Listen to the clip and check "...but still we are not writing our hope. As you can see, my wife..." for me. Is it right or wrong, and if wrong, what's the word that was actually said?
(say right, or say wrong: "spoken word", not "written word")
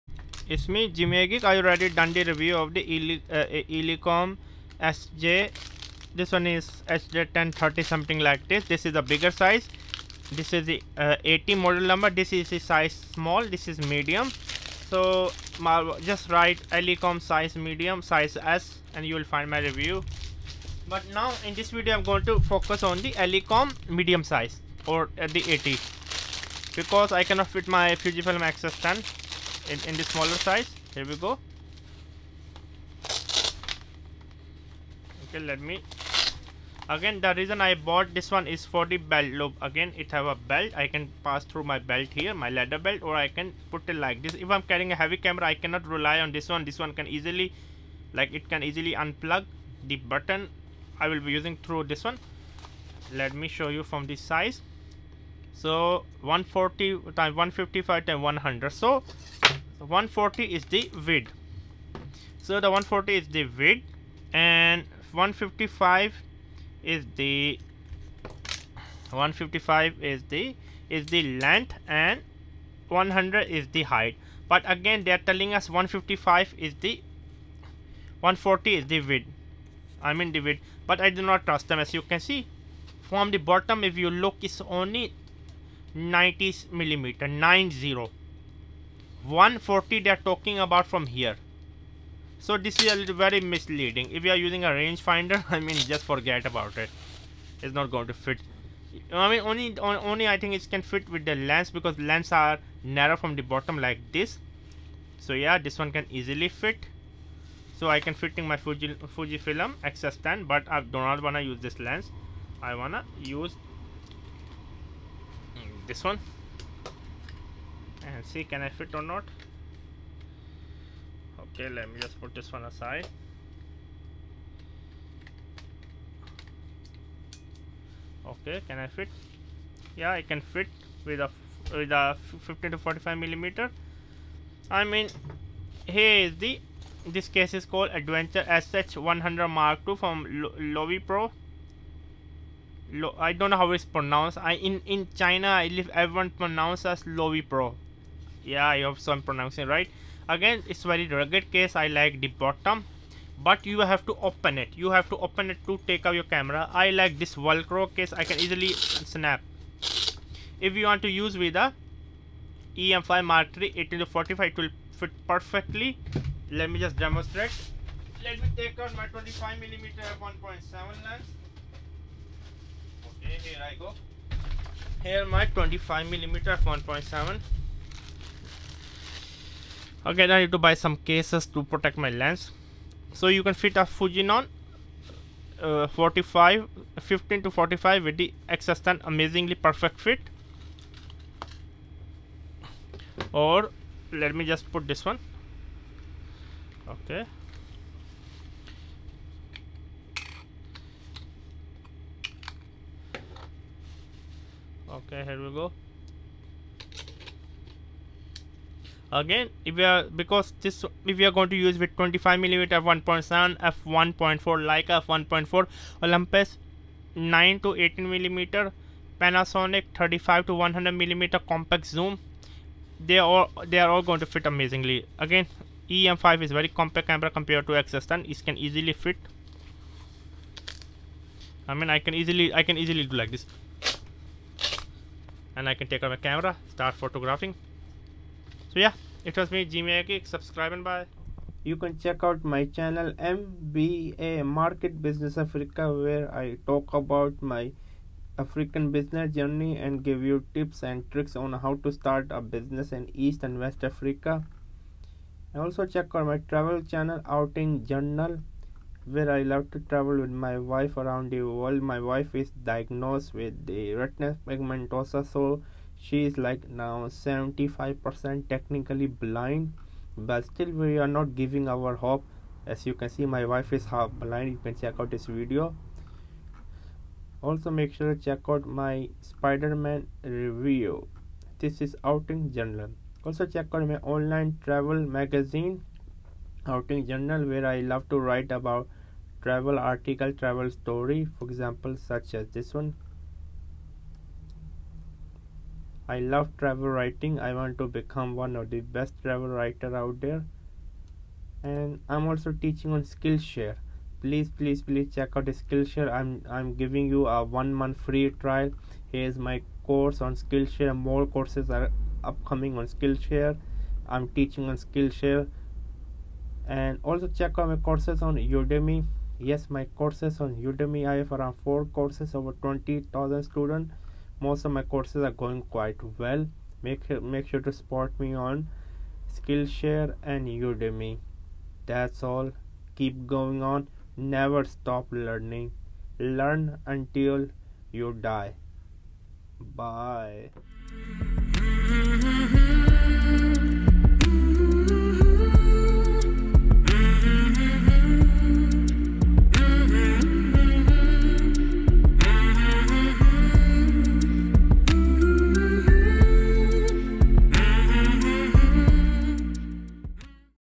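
wrong: "giving", not "writing".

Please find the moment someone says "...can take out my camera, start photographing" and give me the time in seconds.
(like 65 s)
235 s.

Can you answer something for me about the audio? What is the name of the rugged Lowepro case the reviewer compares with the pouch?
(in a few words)
Adventura SH 100 Mark II.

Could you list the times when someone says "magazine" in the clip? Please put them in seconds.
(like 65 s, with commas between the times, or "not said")
284 s.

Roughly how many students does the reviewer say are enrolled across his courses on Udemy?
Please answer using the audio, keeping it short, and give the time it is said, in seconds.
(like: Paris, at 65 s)
over 20,000, at 322 s.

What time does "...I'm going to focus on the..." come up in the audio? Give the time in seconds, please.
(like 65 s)
21 s.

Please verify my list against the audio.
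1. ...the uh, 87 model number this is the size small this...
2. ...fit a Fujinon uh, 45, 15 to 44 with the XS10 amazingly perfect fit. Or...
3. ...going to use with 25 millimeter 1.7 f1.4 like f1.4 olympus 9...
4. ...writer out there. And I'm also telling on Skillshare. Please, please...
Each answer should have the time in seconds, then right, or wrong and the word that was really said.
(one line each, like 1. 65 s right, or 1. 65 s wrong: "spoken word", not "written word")
1. 10 s wrong: "80", not "87"
2. 183 s wrong: "45", not "44"
3. 211 s right
4. 299 s wrong: "teaching", not "telling".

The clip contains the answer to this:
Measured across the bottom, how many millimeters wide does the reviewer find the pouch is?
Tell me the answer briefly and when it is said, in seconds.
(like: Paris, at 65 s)
90, at 84 s.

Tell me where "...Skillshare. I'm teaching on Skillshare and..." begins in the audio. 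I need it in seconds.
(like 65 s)
312 s.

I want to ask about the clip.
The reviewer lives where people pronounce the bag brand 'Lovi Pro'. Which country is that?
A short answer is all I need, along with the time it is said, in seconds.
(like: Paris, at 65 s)
China, at 145 s.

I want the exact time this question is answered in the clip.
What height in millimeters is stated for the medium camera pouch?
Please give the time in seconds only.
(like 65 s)
72 s.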